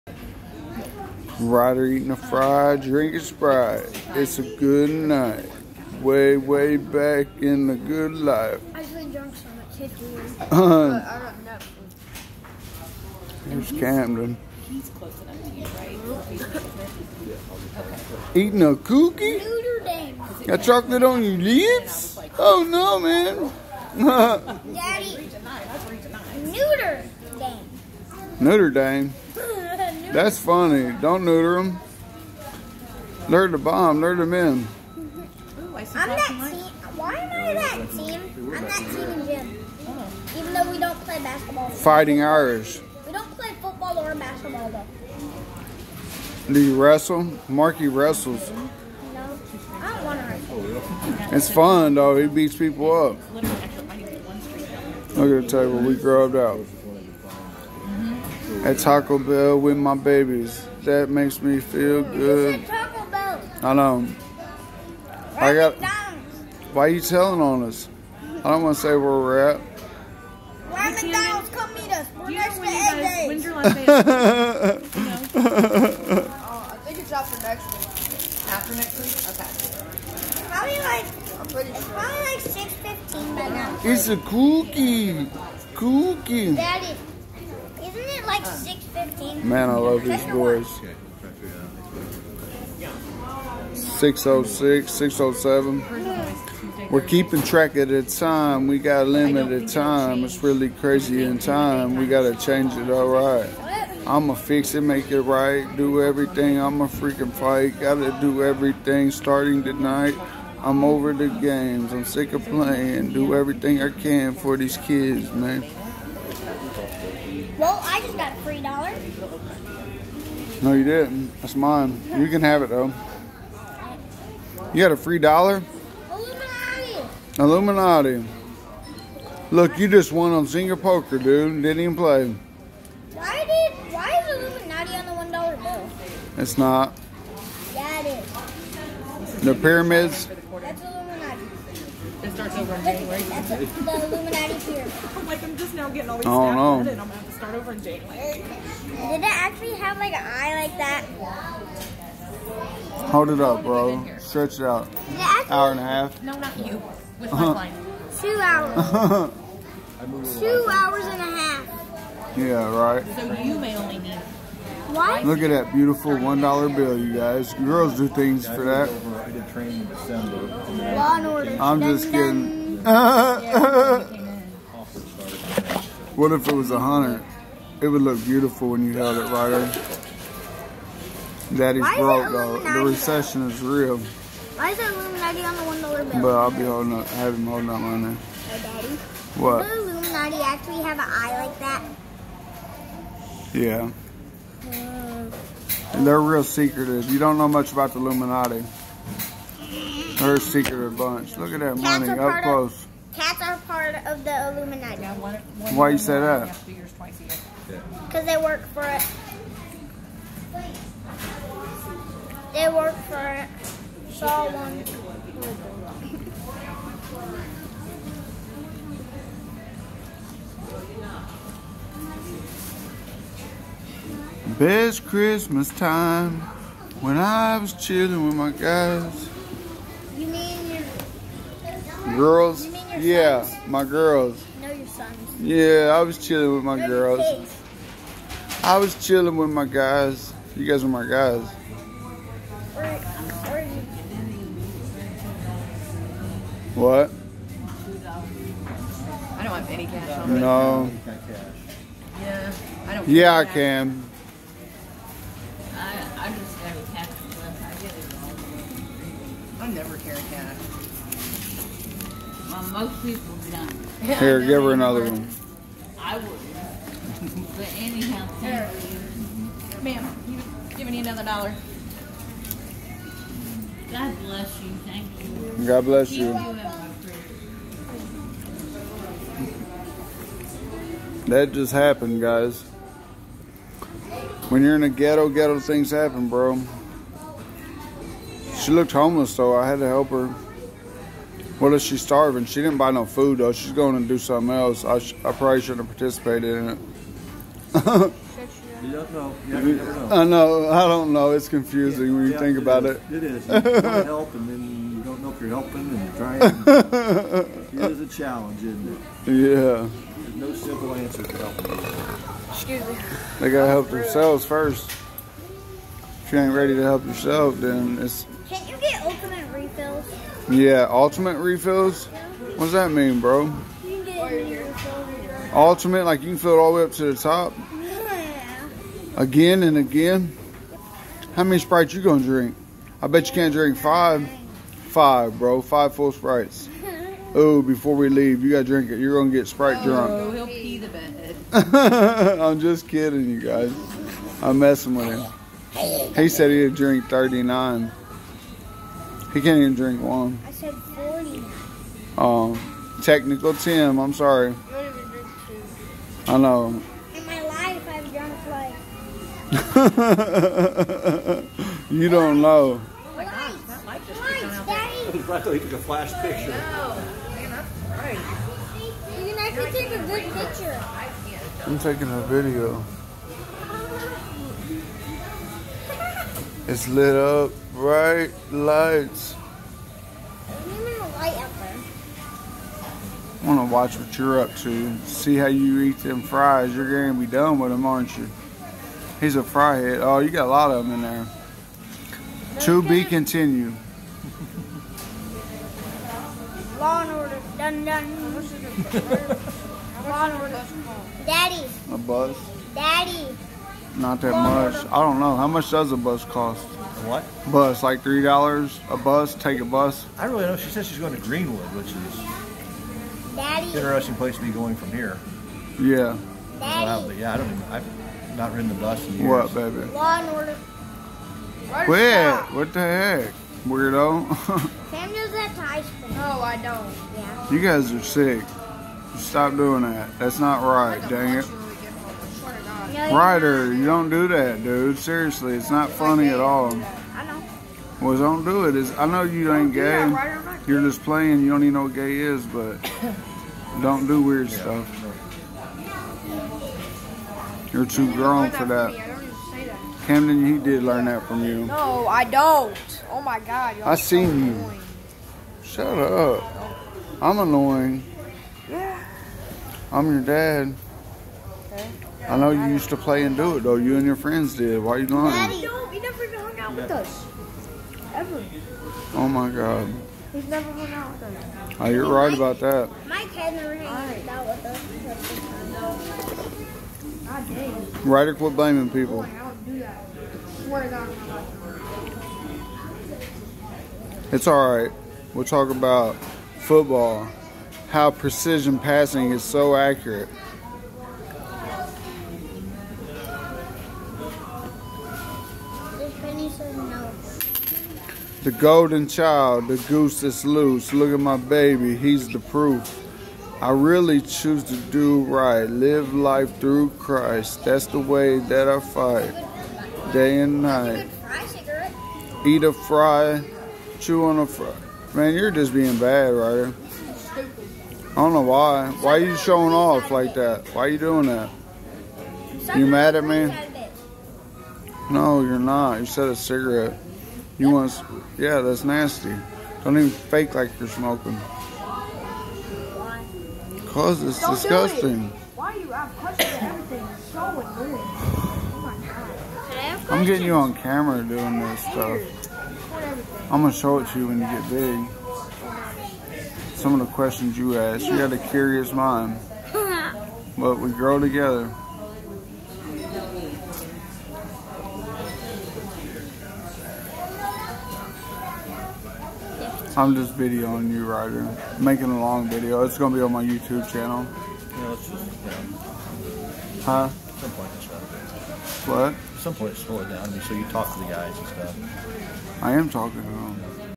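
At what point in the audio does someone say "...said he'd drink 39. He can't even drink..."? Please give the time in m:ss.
5:46.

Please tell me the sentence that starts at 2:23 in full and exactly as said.
the Illuminati I'm like, I'm just now getting all these oh, no.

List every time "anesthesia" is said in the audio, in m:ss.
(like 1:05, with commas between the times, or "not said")
not said.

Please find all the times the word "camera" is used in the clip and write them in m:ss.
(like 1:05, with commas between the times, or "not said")
9:00.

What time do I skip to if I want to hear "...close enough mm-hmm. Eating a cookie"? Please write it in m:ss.
0:14.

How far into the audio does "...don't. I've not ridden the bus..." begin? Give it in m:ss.
6:57.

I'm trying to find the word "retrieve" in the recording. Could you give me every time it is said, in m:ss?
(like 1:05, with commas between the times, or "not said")
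not said.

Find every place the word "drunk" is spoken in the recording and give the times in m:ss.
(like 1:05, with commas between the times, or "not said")
0:09, 5:39, 5:59.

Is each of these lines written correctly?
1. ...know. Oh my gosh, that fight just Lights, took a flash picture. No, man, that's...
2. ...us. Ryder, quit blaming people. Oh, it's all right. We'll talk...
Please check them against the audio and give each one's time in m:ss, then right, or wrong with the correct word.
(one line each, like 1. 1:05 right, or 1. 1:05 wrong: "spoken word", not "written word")
1. 6:02 wrong: "light", not "fight"
2. 7:57 right.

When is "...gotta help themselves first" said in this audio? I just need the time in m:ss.
5:13.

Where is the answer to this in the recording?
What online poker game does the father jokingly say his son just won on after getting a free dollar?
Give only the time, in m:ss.
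2:10.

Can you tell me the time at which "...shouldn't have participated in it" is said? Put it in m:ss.
4:55.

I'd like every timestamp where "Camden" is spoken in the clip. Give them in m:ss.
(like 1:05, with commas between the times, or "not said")
0:13, 7:30.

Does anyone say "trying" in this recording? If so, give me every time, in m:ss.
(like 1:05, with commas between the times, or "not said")
5:06.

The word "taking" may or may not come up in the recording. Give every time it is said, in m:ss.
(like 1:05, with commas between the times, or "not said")
6:11.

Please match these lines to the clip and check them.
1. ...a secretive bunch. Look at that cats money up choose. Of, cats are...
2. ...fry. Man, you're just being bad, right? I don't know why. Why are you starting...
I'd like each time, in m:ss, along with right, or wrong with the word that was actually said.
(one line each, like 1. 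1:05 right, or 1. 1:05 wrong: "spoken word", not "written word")
1. 3:20 wrong: "close", not "choose"
2. 8:34 wrong: "showing", not "starting".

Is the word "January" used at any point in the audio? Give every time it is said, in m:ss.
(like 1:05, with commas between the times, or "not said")
2:22, 2:27.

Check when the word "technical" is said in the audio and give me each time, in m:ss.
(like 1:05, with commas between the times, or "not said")
5:53.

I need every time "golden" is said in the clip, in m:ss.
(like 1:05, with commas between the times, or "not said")
8:18.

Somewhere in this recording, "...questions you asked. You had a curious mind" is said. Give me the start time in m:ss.
9:07.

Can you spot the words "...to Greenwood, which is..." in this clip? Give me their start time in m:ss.
6:51.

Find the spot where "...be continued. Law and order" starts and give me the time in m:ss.
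6:32.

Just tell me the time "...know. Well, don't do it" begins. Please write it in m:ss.
7:17.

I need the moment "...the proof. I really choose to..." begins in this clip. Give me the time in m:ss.
8:22.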